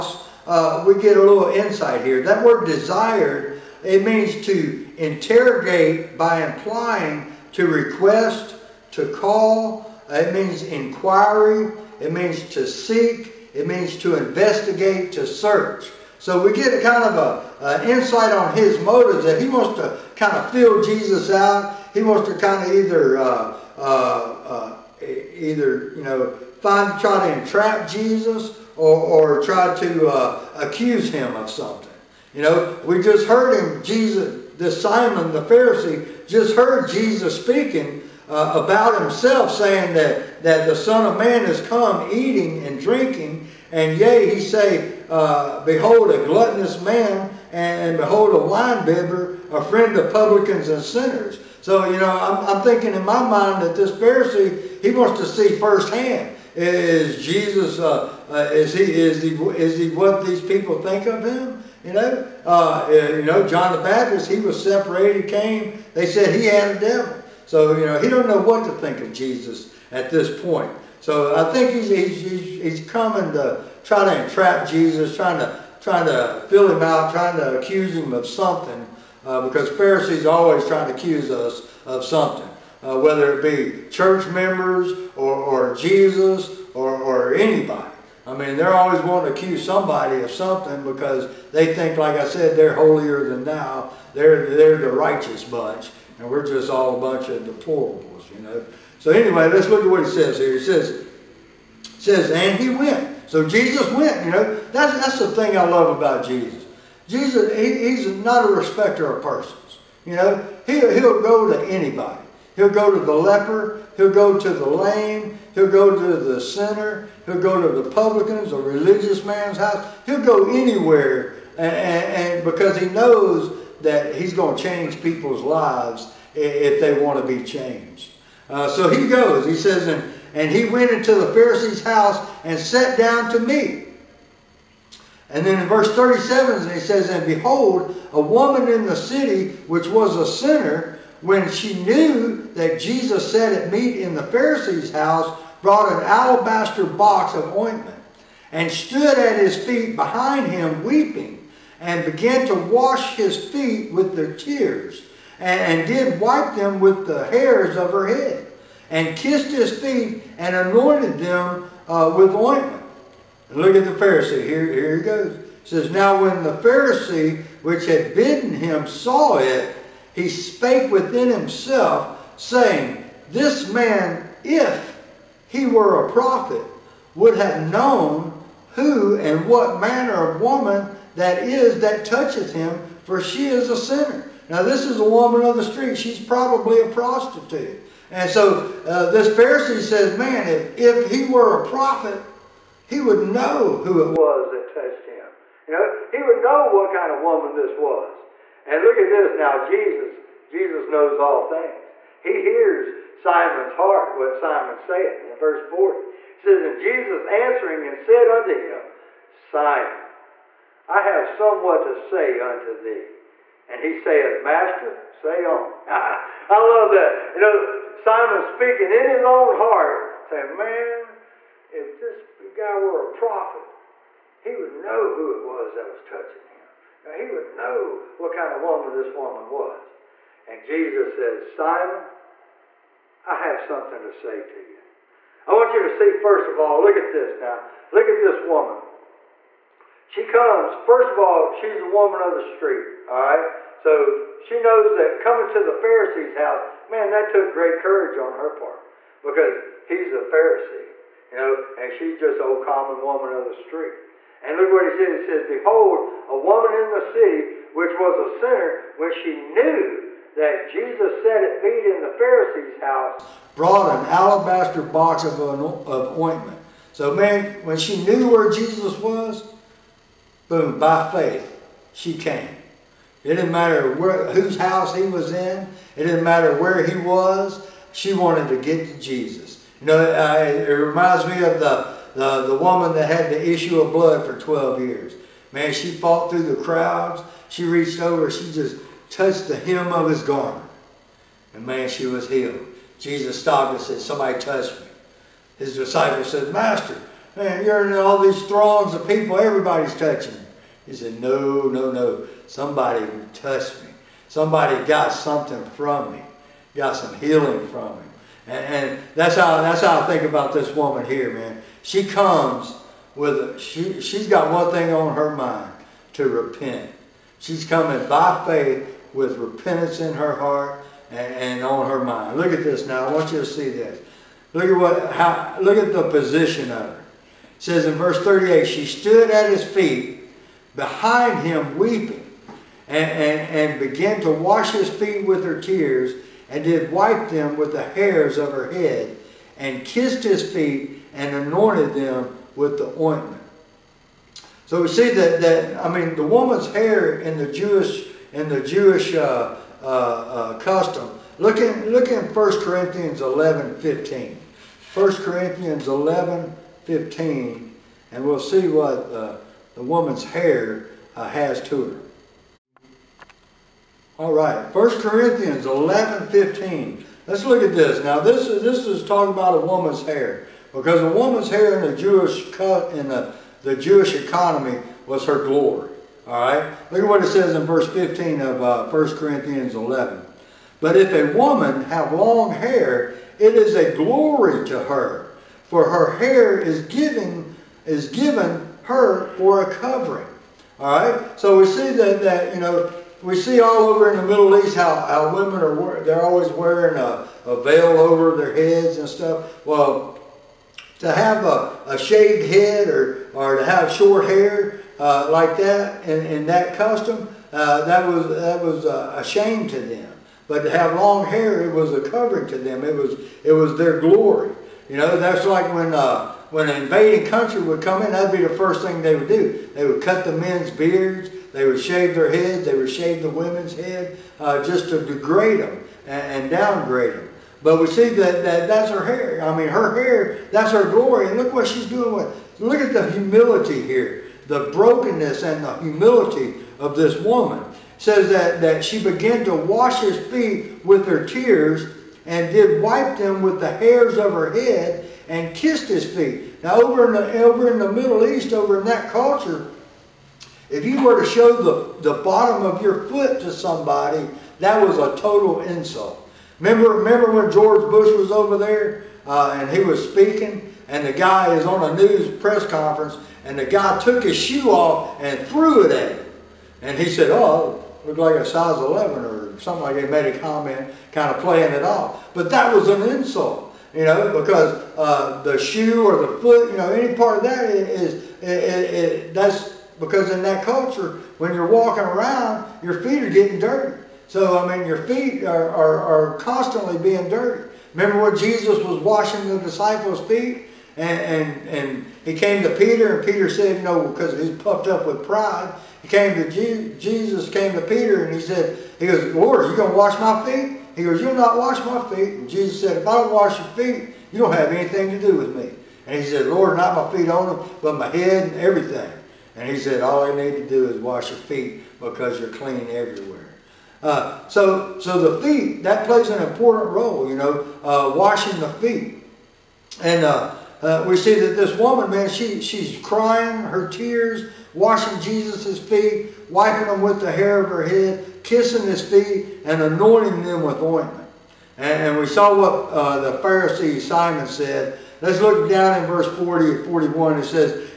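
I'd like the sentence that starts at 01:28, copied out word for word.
I mean, they're always wanting to accuse somebody of something because they think, like I said, they're holier than thou.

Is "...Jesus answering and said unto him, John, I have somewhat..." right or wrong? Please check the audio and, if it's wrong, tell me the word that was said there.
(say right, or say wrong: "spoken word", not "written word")
wrong: "Simon", not "John".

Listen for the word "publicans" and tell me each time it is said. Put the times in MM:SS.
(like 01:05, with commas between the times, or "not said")
00:50, 01:57.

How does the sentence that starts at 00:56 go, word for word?
Is Jesus, uh, uh, is, he, is, he, is he what these people think of him?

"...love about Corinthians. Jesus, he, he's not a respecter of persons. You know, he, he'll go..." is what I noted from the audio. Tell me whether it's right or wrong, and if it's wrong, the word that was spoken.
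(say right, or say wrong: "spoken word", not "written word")
wrong: "Jesus", not "Corinthians".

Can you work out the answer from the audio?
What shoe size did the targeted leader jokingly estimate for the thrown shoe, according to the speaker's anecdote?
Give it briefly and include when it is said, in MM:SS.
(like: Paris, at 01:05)
11, at 07:48.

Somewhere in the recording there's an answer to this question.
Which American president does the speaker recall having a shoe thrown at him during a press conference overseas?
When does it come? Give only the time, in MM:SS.
07:37.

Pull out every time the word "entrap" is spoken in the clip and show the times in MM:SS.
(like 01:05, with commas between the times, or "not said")
00:27, 01:14.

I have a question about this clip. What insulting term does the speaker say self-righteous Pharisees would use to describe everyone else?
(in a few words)
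deplorables.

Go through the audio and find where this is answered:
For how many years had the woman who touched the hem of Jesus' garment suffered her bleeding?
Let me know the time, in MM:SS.
04:44.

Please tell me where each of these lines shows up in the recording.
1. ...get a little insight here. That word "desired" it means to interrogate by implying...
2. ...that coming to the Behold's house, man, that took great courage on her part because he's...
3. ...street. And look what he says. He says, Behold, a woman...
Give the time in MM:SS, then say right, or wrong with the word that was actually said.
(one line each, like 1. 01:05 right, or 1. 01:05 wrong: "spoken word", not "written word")
1. 00:01 right
2. 04:04 wrong: "Pharisee", not "Behold"
3. 04:13 right.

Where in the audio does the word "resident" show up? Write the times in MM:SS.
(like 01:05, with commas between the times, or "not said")
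not said.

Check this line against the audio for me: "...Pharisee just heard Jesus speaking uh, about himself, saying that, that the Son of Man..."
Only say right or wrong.
right.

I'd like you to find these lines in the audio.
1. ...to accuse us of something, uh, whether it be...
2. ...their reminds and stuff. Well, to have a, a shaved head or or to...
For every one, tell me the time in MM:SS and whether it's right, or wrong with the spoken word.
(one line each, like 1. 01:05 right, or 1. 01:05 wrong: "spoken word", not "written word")
1. 01:20 right
2. 06:38 wrong: "heads", not "reminds".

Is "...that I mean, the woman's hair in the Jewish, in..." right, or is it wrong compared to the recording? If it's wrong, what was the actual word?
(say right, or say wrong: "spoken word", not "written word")
right.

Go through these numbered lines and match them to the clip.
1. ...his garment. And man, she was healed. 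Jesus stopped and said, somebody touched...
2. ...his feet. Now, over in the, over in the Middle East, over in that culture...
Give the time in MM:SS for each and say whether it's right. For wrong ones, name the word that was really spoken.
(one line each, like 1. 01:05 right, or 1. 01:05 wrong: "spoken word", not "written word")
1. 04:50 right
2. 07:25 right.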